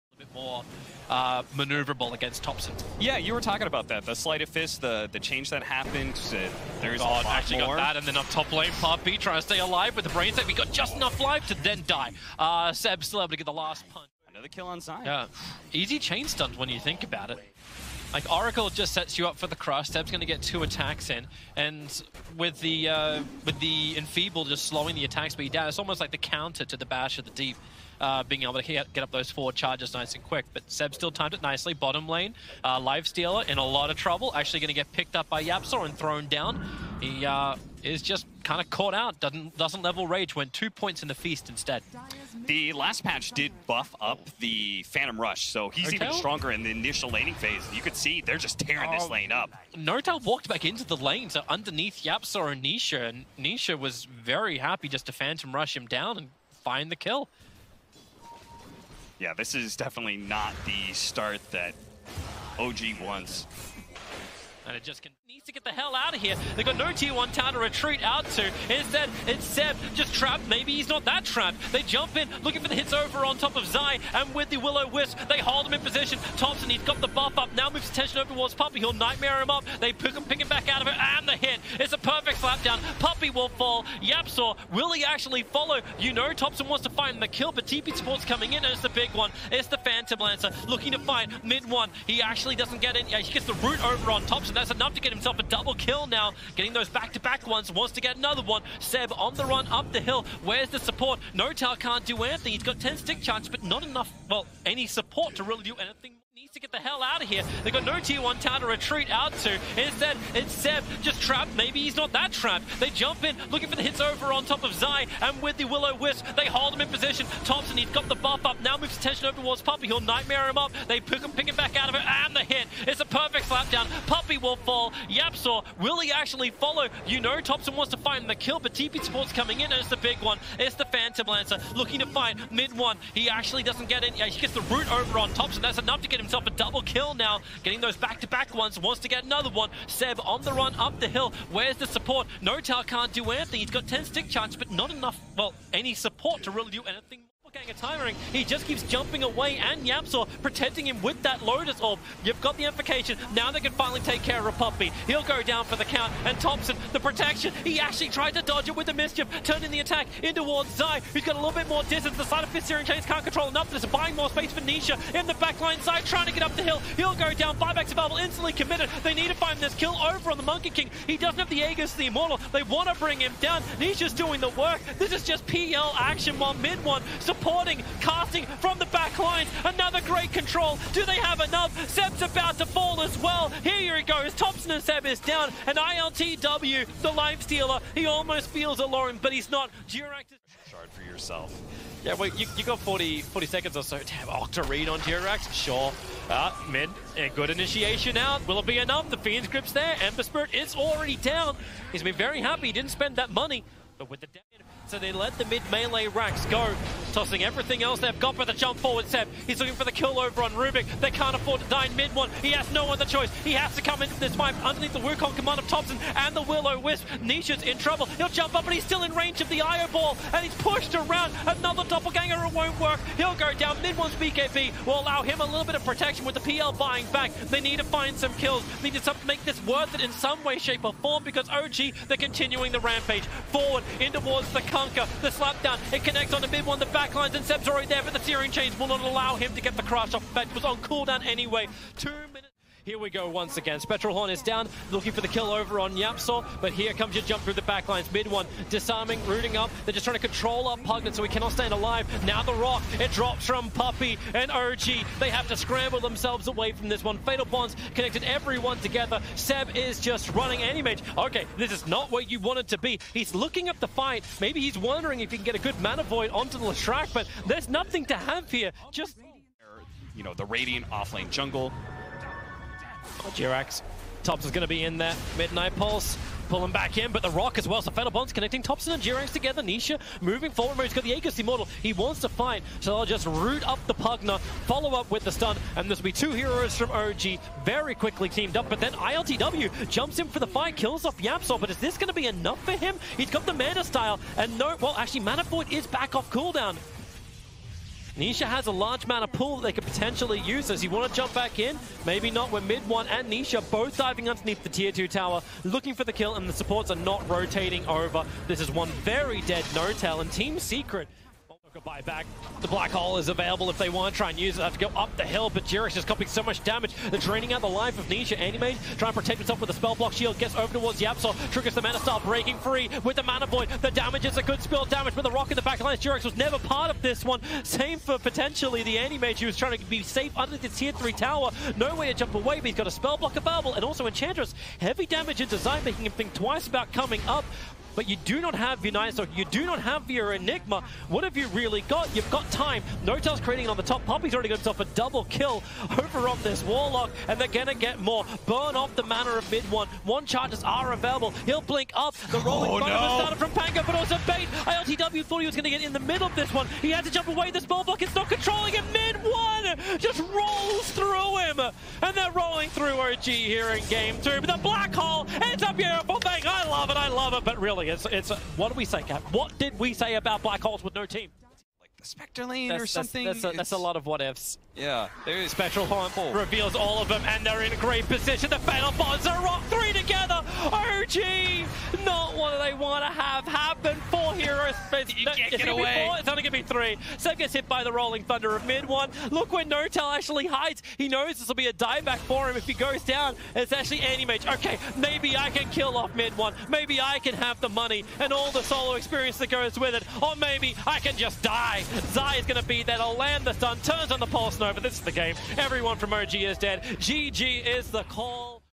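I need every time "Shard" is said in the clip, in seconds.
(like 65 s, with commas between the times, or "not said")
190 s.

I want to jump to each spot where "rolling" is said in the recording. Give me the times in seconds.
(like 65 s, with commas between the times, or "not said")
352 s, 387 s.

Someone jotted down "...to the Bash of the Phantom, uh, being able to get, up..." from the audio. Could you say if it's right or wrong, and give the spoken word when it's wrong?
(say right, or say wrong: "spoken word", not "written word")
wrong: "Deep", not "Phantom".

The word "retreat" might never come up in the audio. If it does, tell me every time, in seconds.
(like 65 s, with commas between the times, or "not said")
67 s, 108 s.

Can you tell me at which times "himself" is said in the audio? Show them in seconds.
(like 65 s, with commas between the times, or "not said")
95 s, 136 s, 319 s, 344 s.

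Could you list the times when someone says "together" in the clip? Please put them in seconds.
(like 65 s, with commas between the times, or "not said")
258 s, 279 s, 379 s.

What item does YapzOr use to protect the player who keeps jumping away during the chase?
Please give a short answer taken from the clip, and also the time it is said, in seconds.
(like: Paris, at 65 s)
Lotus Orb, at 151 s.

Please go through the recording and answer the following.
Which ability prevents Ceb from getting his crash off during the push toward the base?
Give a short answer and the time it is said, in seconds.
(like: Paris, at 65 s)
Searing Chains, at 238 s.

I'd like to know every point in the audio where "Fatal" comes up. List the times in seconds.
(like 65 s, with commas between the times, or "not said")
257 s, 378 s.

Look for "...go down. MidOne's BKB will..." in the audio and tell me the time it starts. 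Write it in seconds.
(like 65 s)
223 s.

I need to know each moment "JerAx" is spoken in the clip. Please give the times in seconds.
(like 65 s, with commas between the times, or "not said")
273 s, 279 s, 315 s, 325 s.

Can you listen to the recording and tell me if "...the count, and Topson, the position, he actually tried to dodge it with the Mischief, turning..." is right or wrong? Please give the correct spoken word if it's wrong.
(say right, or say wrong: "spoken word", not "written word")
wrong: "protection", not "position".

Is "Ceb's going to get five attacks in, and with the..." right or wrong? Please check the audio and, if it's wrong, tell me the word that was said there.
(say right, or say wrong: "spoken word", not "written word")
wrong: "two", not "five".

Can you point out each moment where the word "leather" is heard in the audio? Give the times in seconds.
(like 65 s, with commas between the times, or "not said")
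not said.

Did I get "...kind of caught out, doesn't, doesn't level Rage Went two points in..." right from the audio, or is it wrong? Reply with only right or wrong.
right.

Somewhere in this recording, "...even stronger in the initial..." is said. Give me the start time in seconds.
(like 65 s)
45 s.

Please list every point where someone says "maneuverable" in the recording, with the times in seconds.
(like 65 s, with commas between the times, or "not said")
1 s.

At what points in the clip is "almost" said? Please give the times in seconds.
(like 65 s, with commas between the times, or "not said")
25 s, 188 s.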